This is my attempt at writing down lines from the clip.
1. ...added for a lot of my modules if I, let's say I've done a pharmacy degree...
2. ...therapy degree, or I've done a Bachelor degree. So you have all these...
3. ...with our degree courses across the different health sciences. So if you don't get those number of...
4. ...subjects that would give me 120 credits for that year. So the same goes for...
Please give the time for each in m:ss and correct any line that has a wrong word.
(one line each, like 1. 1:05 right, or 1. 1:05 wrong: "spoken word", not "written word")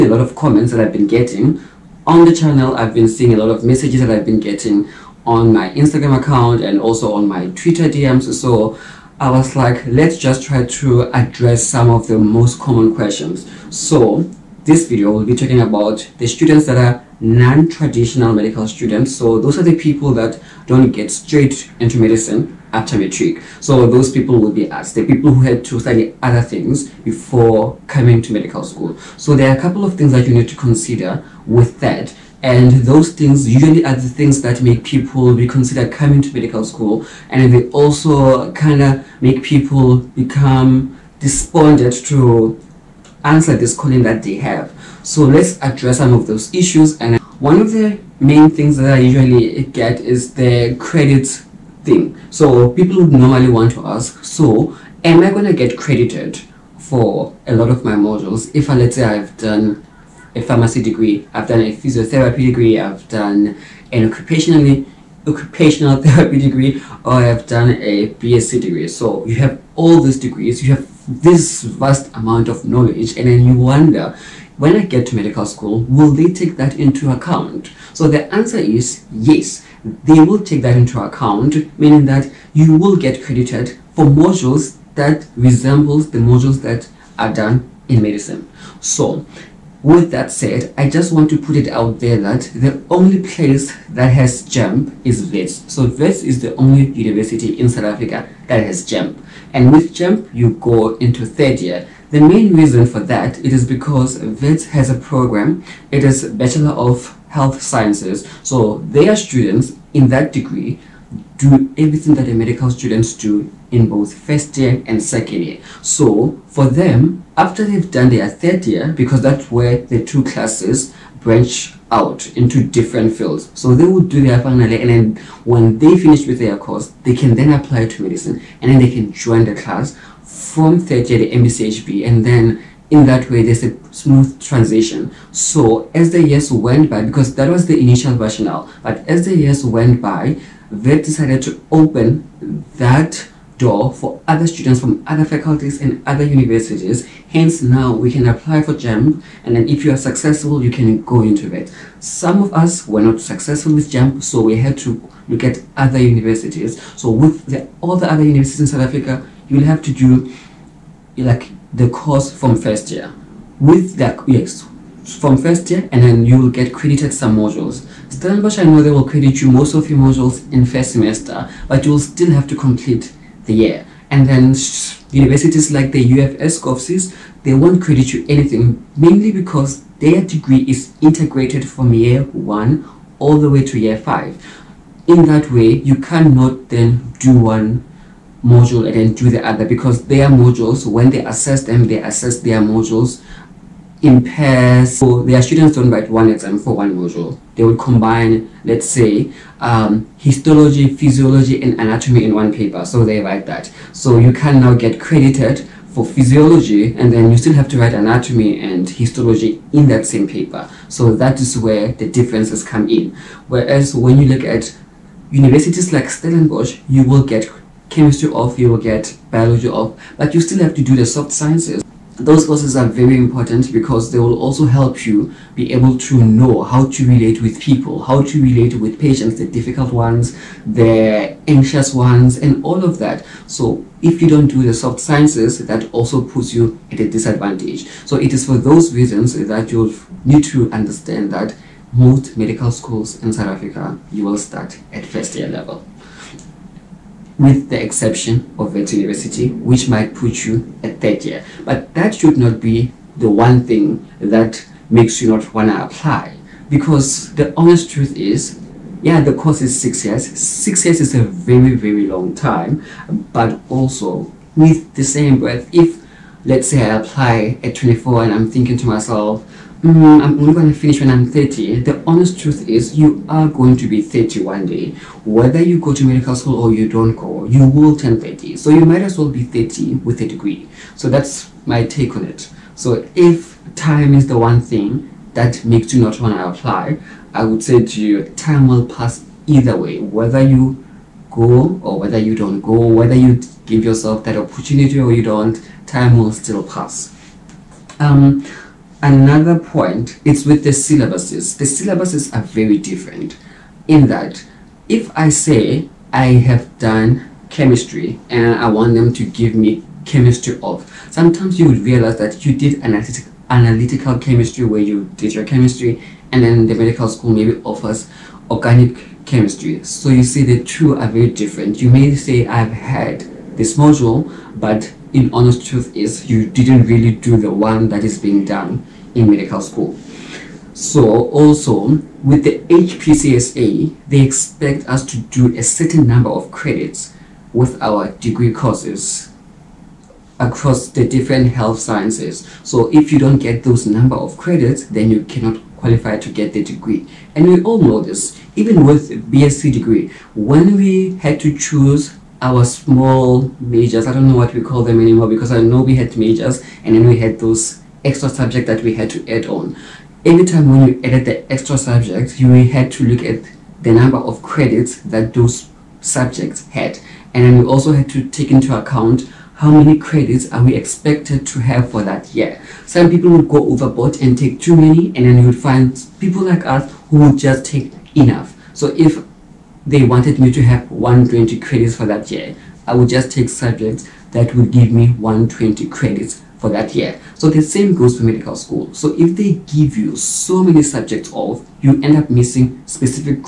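1. 0:55 wrong: "credited", not "added"
2. 1:06 wrong: "BSc", not "Bachelor"
3. 5:37 right
4. 6:23 right.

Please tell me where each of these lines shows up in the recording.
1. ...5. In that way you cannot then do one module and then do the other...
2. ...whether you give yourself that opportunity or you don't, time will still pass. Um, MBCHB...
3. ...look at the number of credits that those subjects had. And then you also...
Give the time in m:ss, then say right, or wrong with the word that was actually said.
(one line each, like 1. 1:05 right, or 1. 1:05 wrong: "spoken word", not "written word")
1. 3:03 right
2. 4:52 wrong: "Another", not "MBCHB"
3. 6:03 right.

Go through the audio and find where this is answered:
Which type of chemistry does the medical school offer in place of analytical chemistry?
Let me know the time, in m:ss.
5:18.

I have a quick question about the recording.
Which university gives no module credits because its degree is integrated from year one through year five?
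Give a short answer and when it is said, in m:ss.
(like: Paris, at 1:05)
UFS, at 2:56.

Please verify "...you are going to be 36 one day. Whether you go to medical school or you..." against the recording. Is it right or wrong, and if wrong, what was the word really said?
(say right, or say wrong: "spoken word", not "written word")
wrong: "30", not "36".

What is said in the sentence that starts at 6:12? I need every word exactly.
Some people would go overboard and take too many and then you would find people like us who would just take enough.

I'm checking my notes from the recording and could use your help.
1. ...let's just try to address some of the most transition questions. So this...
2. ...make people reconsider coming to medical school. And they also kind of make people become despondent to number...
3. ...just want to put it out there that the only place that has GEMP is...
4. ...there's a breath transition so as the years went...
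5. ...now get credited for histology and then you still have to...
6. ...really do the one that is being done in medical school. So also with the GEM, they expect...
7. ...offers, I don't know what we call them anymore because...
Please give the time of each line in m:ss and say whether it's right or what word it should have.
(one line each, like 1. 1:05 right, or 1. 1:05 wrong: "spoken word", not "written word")
1. 0:09 wrong: "common", not "transition"
2. 0:34 wrong: "answer", not "number"
3. 1:30 right
4. 2:13 wrong: "smooth", not "breath"
5. 3:24 wrong: "physiology", not "histology"
6. 5:26 wrong: "HPCSA", not "GEM"
7. 5:53 wrong: "majors", not "offers".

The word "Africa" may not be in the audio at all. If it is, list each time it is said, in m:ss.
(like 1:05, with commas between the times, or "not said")
1:37, 2:38, 4:03.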